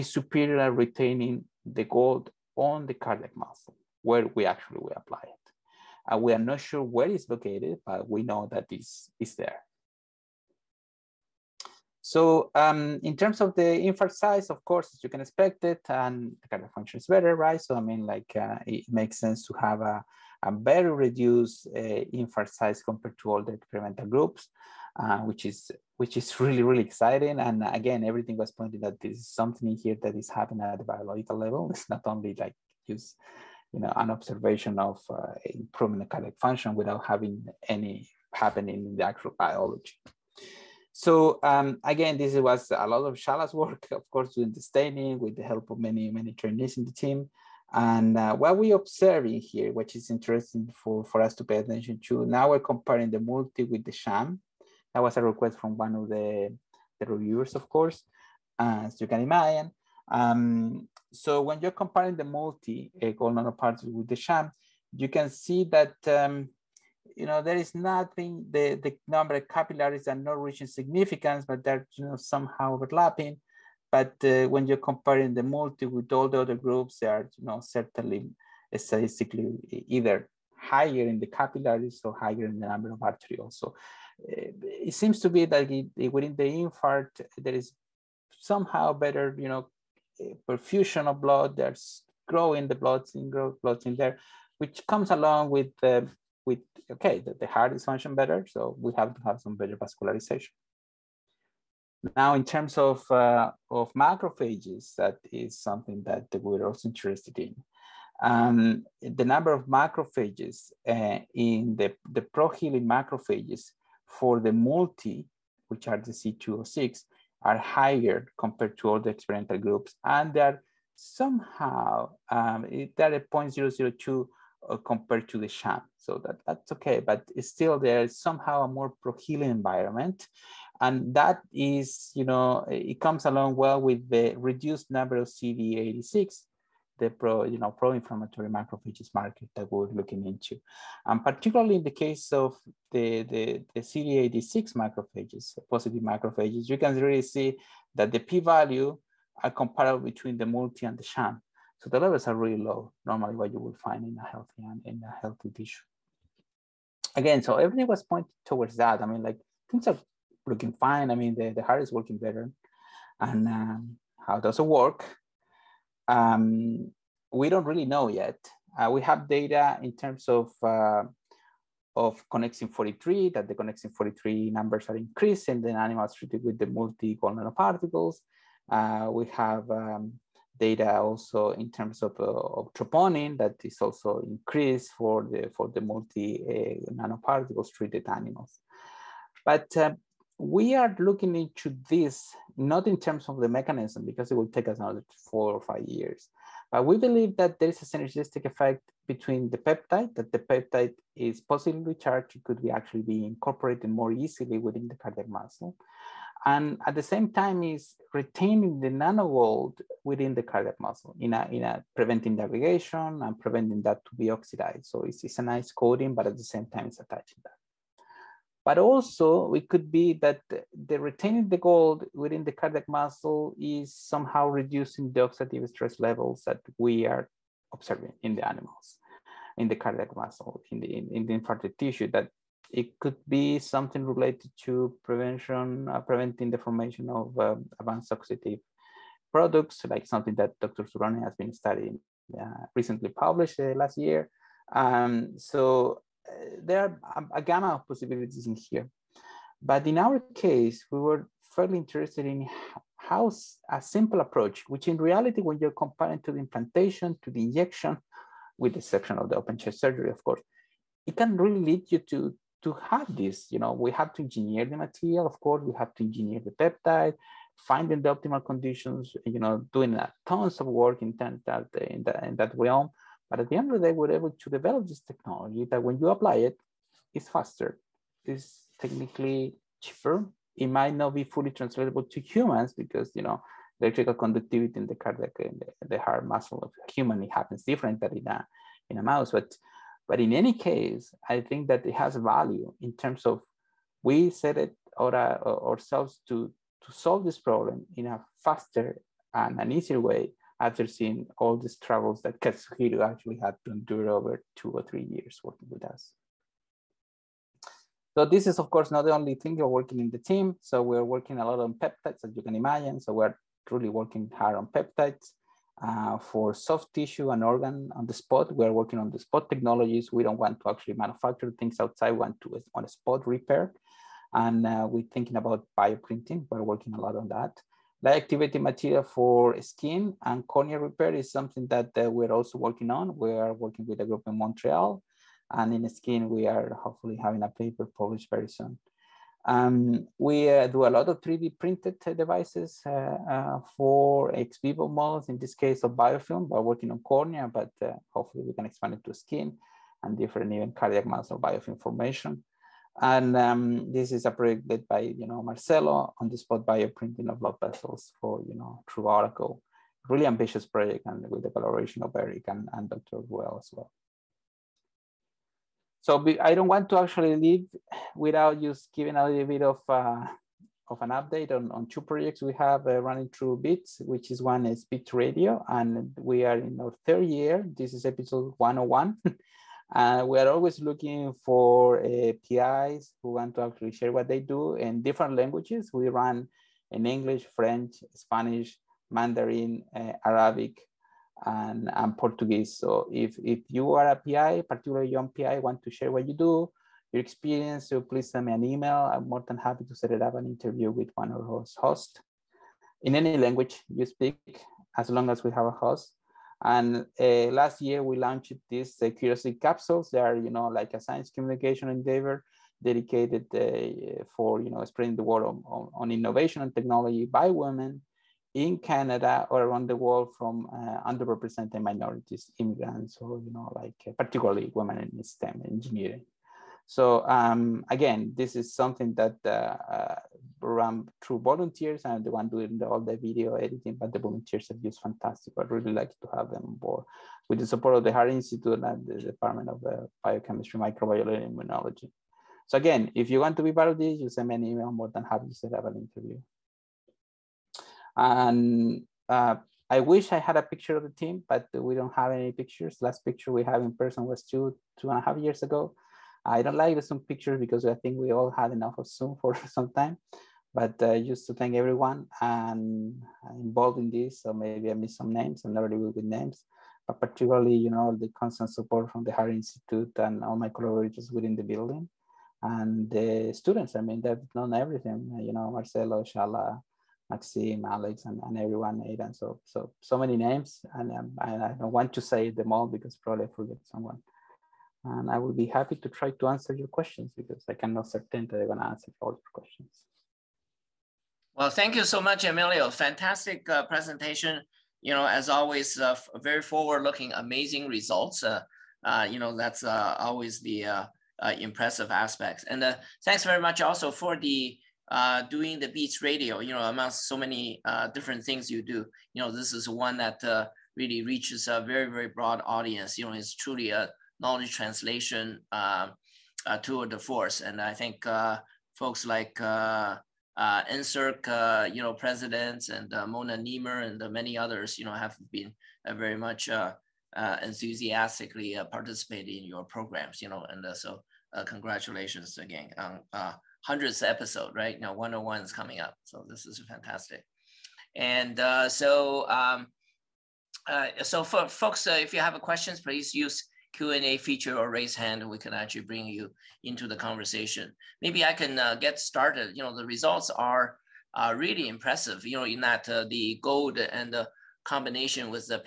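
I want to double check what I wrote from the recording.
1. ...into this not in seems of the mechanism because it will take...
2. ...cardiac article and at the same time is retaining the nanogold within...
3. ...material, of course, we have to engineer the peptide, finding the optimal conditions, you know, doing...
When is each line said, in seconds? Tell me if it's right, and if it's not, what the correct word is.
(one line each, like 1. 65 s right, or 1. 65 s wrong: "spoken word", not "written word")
1. 191 s wrong: "terms", not "seems"
2. 204 s wrong: "muscle", not "article"
3. 264 s right.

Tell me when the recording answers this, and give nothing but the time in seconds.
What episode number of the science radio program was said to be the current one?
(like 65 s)
378 s.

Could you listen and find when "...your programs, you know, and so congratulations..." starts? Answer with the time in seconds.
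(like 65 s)
529 s.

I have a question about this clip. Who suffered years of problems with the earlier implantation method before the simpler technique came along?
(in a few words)
Katsuhiro.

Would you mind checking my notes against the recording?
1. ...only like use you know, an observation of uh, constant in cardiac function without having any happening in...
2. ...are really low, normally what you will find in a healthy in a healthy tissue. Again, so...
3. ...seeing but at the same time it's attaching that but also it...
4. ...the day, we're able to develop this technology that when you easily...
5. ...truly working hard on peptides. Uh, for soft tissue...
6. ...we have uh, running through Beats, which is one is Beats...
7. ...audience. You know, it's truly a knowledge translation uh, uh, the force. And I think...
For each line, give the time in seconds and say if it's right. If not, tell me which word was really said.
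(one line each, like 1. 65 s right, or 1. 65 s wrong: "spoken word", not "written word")
1. 32 s wrong: "improvement", not "constant"
2. 152 s right
3. 215 s wrong: "coating", not "seeing"
4. 273 s wrong: "apply", not "easily"
5. 313 s right
6. 372 s right
7. 512 s right.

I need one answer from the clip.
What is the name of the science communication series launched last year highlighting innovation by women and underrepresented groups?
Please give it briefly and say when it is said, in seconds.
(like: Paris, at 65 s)
curiosity capsules, at 409 s.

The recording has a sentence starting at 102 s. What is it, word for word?
Now, in terms of uh, of macrophages, that is something that we're also interested in.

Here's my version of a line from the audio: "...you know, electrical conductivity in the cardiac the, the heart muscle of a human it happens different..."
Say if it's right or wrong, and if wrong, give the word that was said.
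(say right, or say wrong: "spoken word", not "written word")
right.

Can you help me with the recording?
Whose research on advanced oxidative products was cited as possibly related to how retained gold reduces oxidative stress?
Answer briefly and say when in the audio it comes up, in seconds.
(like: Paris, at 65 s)
Dr. Suuronen, at 240 s.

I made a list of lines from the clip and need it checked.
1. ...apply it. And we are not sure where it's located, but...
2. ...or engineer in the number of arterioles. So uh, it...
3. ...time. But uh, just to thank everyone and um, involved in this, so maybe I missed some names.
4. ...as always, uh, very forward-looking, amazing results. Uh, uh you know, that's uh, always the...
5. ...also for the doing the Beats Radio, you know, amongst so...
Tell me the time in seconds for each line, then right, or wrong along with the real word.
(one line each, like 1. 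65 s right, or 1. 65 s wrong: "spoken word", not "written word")
1. 4 s right
2. 82 s wrong: "higher", not "engineer"
3. 459 s right
4. 495 s right
5. 503 s right.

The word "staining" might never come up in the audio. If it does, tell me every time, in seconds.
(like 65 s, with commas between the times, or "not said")
44 s.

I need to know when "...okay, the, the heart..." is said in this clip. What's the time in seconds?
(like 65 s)
96 s.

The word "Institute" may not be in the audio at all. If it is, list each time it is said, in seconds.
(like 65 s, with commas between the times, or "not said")
438 s, 469 s.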